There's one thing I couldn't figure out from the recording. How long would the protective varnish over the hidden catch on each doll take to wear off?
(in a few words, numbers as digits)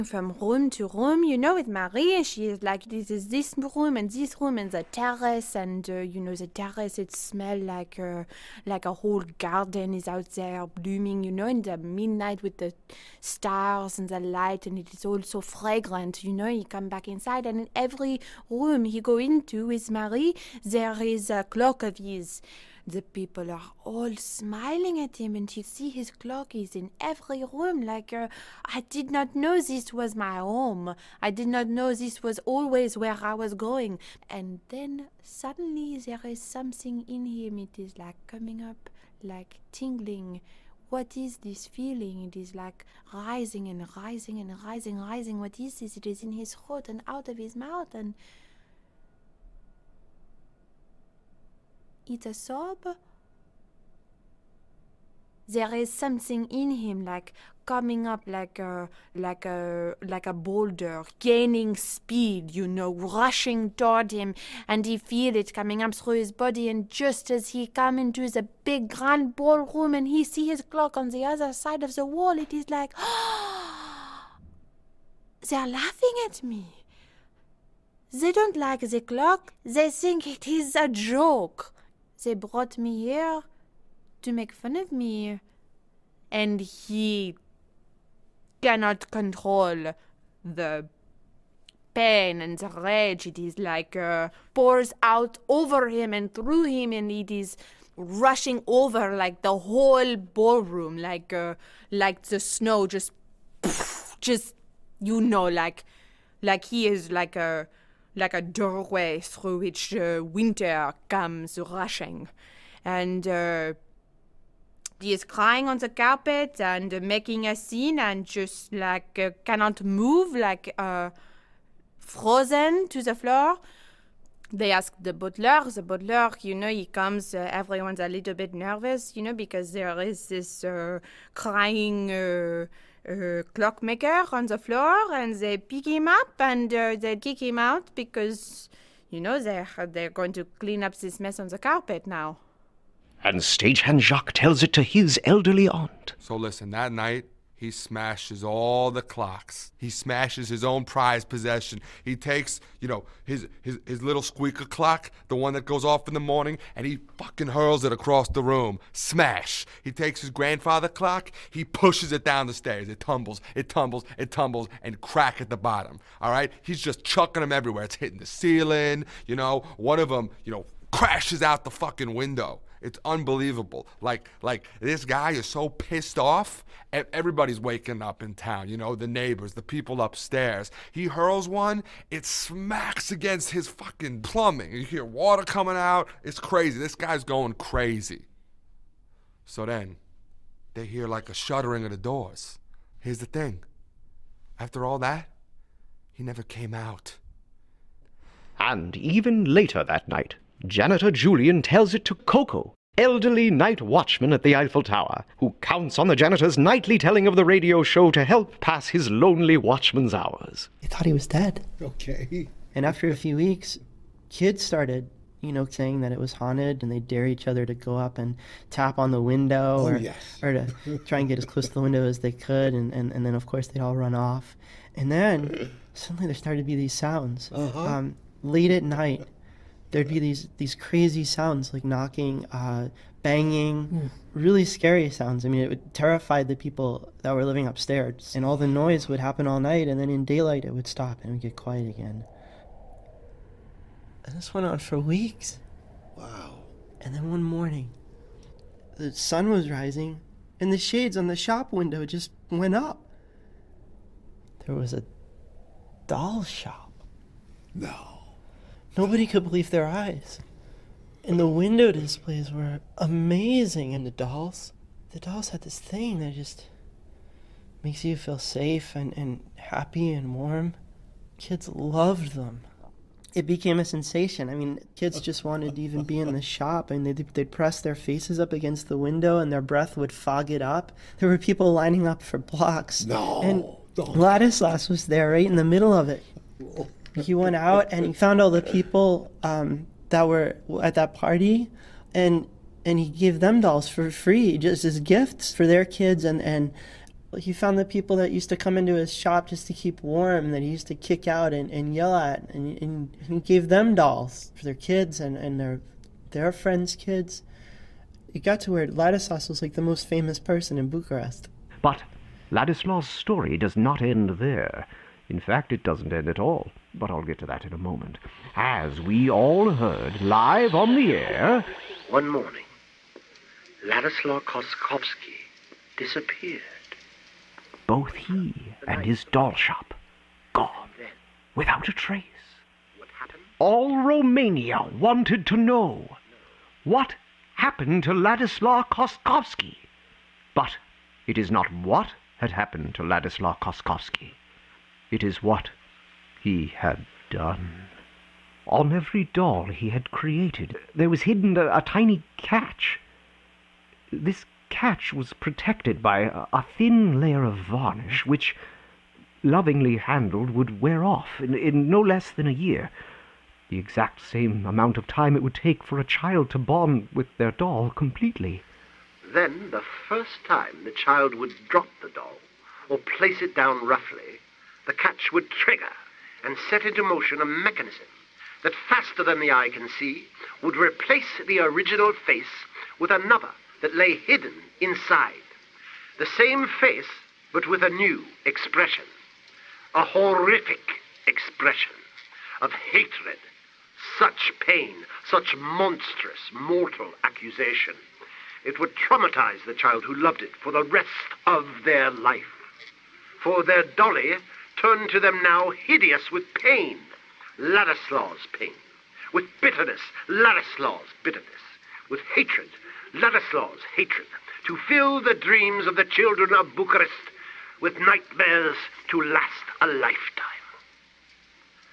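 A year.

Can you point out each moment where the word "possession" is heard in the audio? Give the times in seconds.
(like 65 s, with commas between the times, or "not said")
151 s.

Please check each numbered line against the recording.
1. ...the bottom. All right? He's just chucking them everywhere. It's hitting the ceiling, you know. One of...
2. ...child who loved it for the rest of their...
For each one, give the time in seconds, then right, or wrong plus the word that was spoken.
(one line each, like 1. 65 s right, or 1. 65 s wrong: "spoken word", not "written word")
1. 165 s right
2. 399 s right.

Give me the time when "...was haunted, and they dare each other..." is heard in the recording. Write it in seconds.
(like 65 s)
216 s.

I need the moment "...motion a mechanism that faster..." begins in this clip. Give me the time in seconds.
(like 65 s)
377 s.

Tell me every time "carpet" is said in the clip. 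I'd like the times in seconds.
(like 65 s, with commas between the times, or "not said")
115 s, 141 s.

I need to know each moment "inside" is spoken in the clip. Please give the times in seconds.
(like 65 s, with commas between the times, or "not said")
17 s, 384 s.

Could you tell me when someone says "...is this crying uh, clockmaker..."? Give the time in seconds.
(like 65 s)
130 s.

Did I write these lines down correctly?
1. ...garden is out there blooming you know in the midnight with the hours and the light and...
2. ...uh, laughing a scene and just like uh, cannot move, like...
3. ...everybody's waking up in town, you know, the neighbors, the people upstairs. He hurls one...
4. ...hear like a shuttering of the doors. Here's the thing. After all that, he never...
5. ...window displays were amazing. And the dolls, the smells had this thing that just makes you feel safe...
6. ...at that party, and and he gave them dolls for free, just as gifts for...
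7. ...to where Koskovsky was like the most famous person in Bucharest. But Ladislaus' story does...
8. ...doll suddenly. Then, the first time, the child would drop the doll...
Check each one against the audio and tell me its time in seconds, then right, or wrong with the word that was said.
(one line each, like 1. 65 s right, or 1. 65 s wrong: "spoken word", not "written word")
1. 9 s wrong: "stars", not "hours"
2. 116 s wrong: "making", not "laughing"
3. 176 s right
4. 190 s right
5. 261 s wrong: "dolls", not "smells"
6. 290 s right
7. 308 s wrong: "Ladislaus", not "Koskovsky"
8. 367 s wrong: "completely", not "suddenly".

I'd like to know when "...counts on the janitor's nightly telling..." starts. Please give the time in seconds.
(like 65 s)
205 s.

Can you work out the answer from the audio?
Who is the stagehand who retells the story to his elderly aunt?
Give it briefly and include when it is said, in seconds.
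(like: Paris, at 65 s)
Jacques, at 143 s.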